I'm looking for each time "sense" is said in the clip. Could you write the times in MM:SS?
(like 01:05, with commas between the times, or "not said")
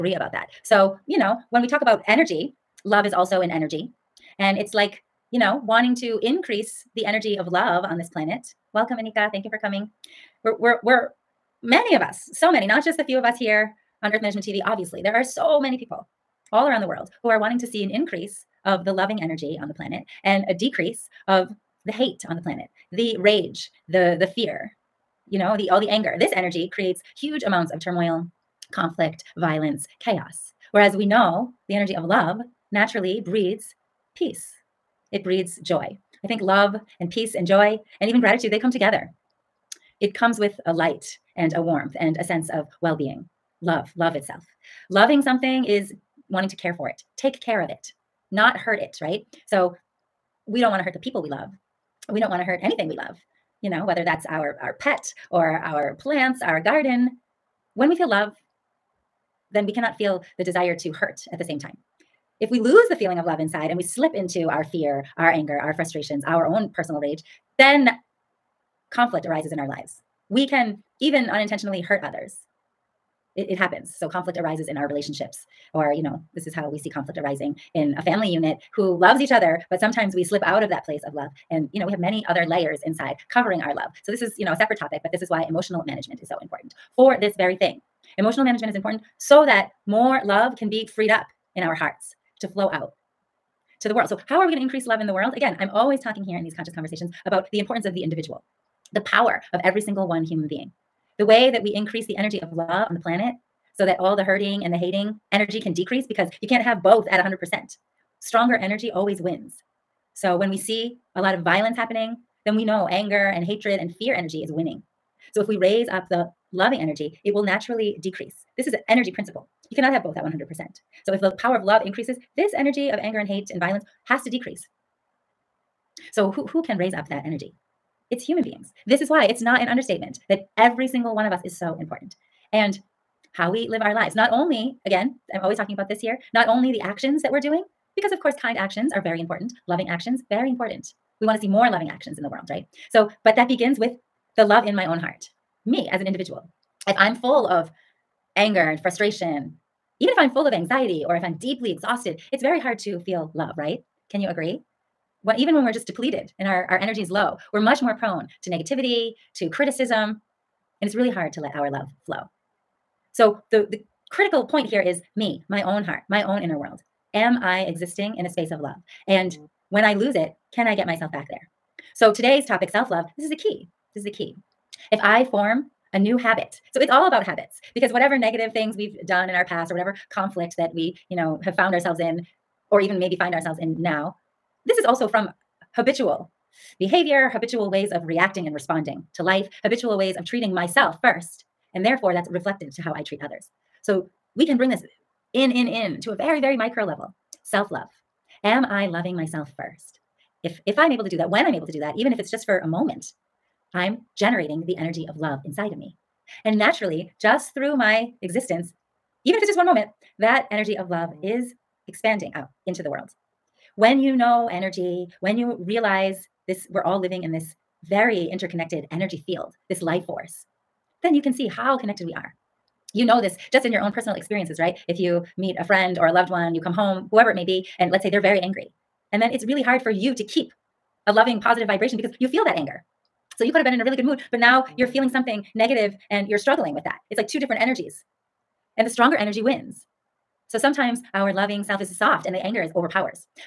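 00:42.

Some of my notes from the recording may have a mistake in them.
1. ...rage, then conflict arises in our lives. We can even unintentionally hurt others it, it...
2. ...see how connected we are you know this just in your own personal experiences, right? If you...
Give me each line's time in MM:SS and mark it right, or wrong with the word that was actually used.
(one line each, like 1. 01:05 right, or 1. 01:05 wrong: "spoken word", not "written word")
1. 01:06 right
2. 03:41 right.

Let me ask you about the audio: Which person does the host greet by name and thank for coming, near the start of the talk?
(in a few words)
Anika.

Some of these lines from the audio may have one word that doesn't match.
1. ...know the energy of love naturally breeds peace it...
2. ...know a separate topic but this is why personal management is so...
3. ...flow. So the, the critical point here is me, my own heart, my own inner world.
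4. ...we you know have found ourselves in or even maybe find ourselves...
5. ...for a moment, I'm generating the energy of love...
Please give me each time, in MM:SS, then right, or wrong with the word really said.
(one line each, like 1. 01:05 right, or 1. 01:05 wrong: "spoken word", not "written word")
1. 00:31 right
2. 01:24 wrong: "emotional", not "personal"
3. 02:42 right
4. 03:00 right
5. 03:22 right.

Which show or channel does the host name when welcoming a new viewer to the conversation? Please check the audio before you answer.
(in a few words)
Earth Management TV.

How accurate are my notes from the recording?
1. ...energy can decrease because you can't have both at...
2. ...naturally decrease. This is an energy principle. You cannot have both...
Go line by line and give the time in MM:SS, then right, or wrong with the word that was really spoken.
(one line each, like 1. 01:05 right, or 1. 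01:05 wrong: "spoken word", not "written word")
1. 01:45 right
2. 01:57 right.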